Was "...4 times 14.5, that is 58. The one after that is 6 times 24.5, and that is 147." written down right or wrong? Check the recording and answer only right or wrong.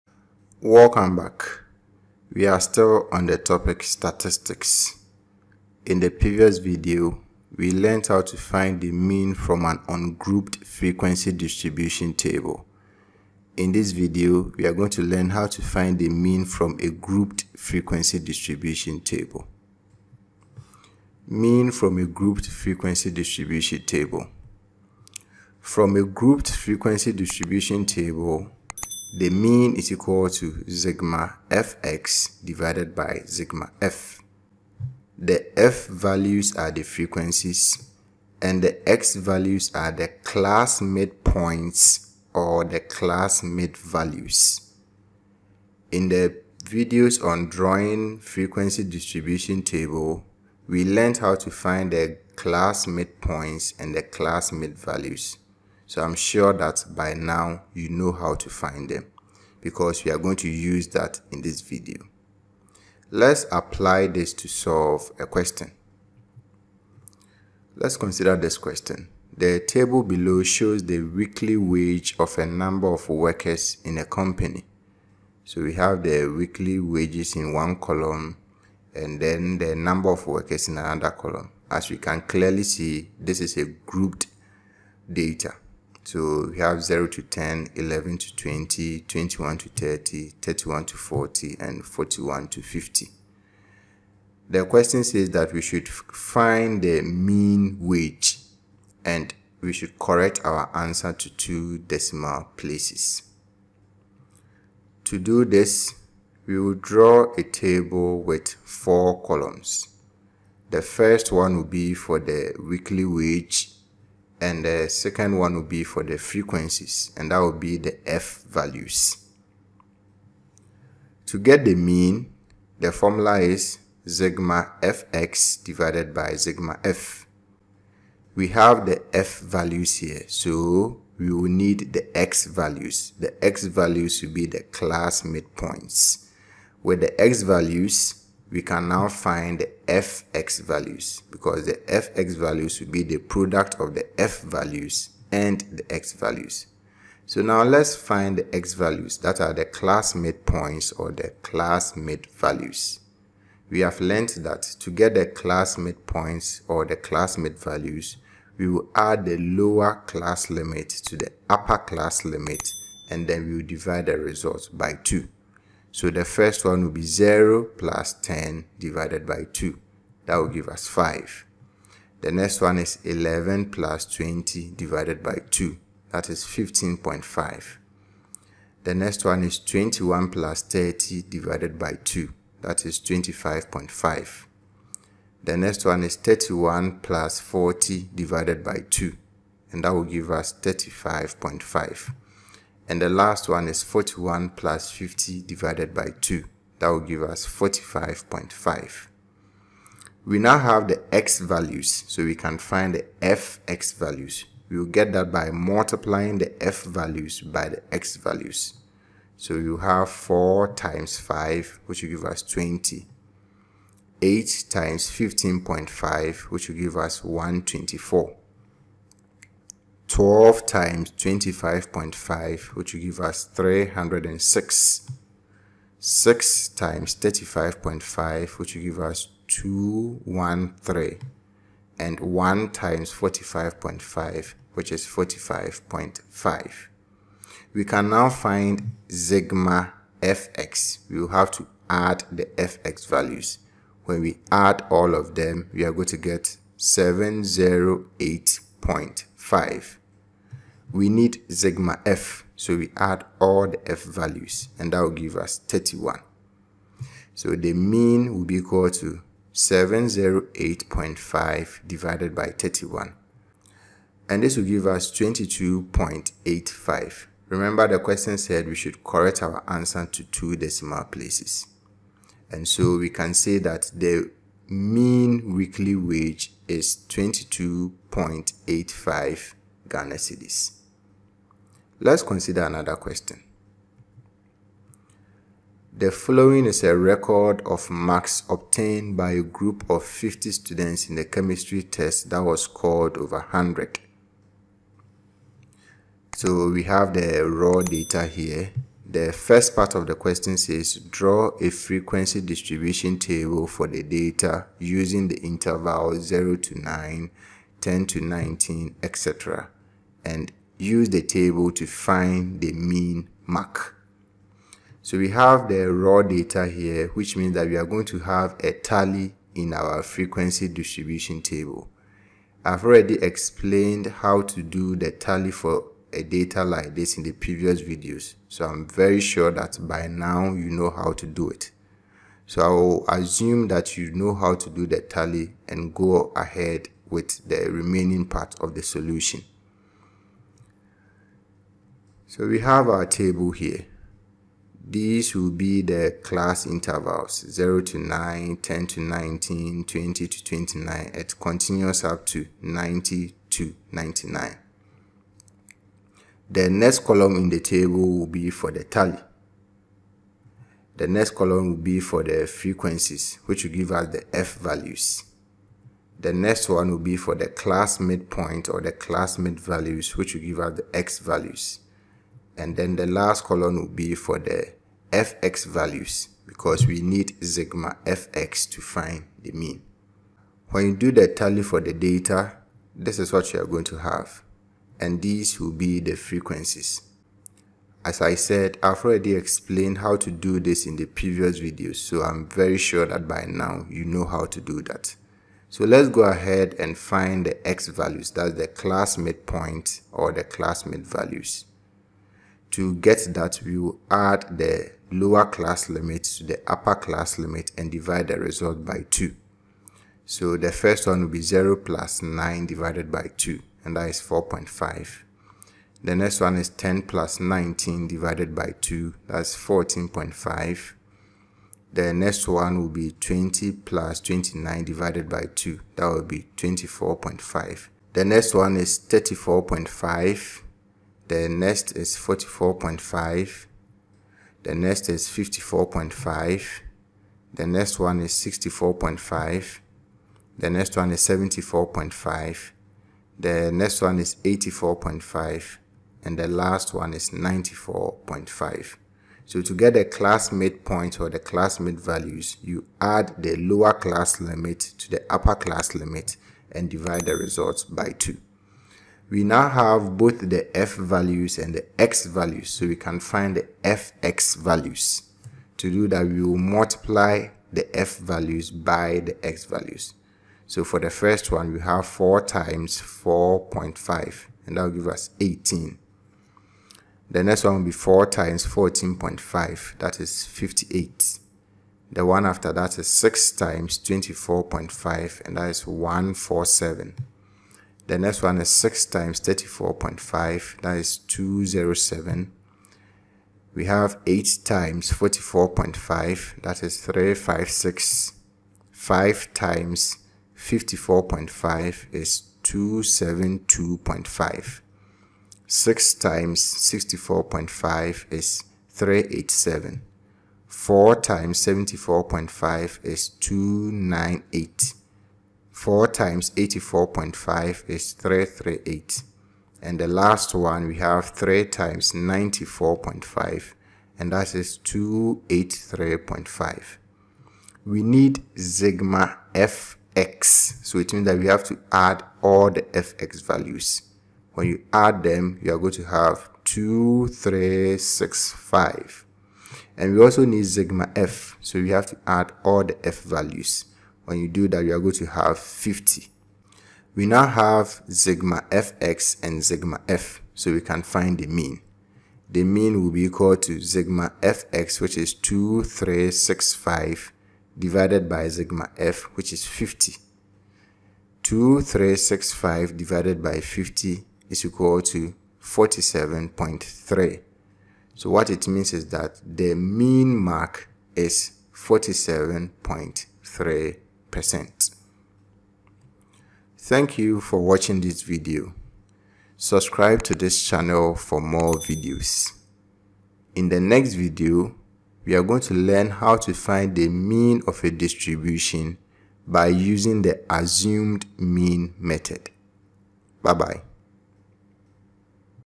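right.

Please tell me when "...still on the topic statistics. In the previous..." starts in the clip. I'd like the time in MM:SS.
00:02.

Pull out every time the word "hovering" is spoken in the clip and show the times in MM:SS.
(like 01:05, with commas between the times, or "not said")
not said.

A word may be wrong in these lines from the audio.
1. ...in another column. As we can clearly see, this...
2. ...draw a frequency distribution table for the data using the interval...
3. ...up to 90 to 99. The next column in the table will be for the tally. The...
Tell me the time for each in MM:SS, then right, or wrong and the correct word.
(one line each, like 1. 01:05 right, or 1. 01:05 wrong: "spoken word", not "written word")
1. 01:20 right
2. 05:00 right
3. 05:52 right.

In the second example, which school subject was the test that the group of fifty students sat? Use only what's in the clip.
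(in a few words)
chemistry.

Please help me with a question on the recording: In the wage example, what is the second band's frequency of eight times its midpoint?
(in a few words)
124.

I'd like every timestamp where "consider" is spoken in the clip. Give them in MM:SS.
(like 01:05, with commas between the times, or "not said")
01:07, 04:42.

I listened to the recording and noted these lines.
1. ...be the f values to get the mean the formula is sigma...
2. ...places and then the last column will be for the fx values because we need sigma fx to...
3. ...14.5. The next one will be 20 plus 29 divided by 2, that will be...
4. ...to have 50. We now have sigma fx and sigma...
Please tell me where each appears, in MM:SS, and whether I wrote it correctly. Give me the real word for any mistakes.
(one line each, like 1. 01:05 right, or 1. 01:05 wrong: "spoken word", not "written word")
1. 01:57 right
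2. 06:11 wrong: "values", not "places"
3. 06:59 right
4. 09:05 right.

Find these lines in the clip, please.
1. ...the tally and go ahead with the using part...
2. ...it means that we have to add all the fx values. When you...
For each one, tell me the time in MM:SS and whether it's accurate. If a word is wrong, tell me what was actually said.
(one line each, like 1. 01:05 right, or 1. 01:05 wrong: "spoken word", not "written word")
1. 05:34 wrong: "remaining", not "using"
2. 08:50 right.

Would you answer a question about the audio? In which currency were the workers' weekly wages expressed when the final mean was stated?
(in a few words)
Ghana cedis.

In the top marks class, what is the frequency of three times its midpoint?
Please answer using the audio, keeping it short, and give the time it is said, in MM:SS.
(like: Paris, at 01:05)
283.5, at 08:44.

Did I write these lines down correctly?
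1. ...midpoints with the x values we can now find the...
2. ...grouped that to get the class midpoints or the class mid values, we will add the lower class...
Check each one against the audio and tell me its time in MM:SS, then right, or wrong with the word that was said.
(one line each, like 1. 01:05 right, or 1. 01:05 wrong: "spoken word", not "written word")
1. 02:15 right
2. 02:34 wrong: "learned", not "grouped".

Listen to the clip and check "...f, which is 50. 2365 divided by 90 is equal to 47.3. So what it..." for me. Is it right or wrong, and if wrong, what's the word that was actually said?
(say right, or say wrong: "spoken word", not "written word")
wrong: "50", not "90".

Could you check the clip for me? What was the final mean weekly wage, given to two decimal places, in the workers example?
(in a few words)
22.85.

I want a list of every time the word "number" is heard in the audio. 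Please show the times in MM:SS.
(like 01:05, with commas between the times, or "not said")
01:12, 01:19.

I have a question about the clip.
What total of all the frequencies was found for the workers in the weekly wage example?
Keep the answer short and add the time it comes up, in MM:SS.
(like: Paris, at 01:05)
31, at 04:14.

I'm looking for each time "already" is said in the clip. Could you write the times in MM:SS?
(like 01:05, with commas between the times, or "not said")
05:22, 06:29.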